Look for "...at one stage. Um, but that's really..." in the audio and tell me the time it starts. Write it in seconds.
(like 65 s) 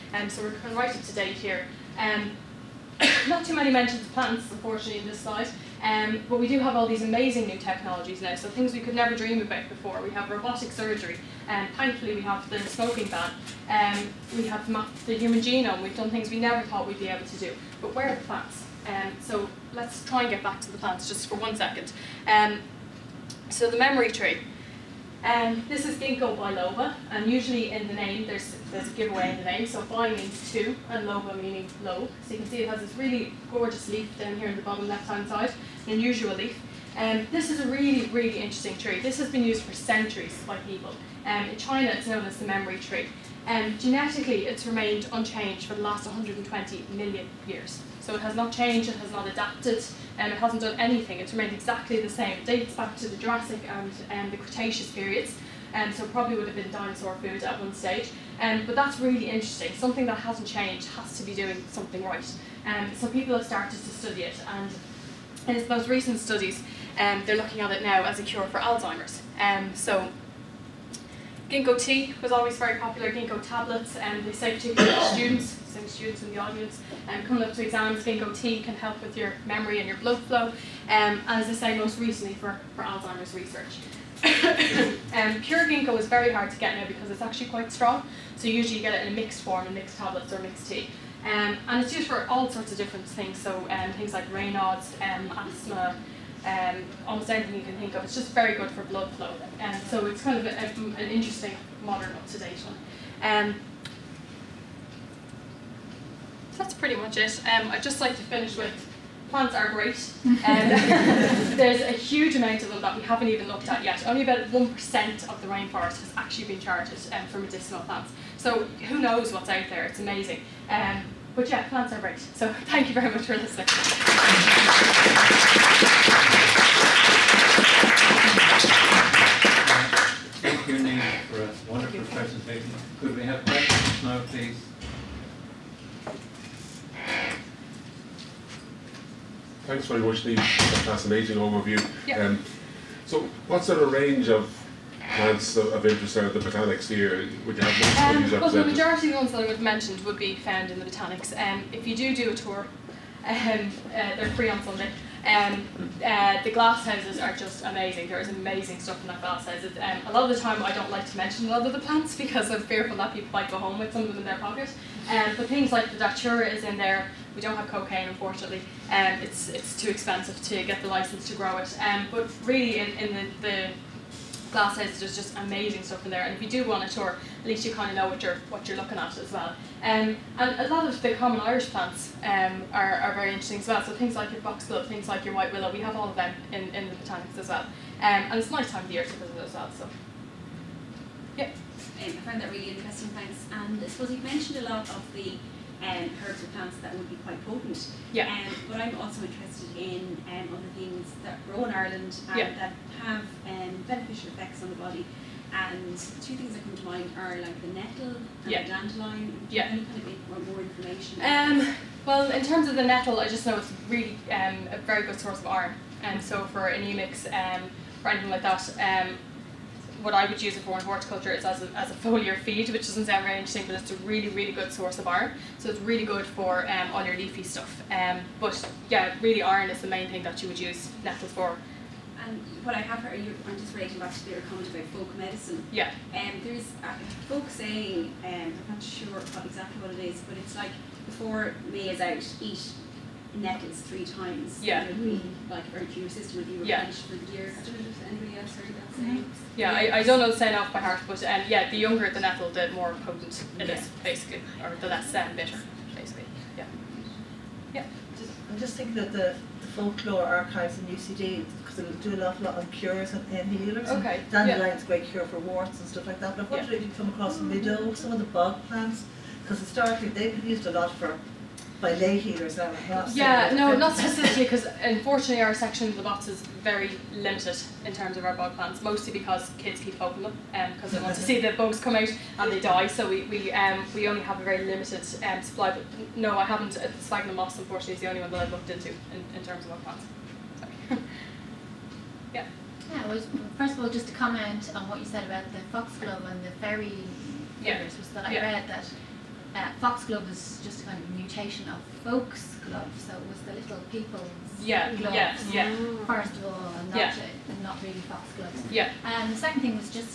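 57 s.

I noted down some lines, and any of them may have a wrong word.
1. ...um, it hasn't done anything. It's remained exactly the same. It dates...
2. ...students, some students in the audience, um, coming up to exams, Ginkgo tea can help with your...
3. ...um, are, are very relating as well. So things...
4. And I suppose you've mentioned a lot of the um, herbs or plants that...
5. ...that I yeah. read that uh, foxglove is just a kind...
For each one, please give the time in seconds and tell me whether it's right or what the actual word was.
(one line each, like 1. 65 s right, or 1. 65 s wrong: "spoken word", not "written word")
1. 50 s right
2. 75 s right
3. 182 s wrong: "interesting", not "relating"
4. 193 s right
5. 298 s right.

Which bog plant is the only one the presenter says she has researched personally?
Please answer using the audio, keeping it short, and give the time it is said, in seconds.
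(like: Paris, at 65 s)
Sphagnum moss, at 286 s.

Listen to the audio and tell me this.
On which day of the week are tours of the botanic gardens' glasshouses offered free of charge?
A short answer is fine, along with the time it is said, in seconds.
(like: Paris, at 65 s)
Sunday, at 154 s.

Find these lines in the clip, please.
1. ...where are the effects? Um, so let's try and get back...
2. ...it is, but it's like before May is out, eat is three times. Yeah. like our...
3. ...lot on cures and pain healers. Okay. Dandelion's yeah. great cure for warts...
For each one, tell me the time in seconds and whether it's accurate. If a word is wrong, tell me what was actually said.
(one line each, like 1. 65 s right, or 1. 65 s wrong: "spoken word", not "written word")
1. 17 s wrong: "plants", not "effects"
2. 239 s right
3. 262 s right.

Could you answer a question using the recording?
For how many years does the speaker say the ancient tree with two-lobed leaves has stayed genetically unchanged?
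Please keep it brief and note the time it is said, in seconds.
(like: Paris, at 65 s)
120 million years, at 46 s.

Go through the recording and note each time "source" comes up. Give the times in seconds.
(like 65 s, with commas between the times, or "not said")
215 s, 224 s.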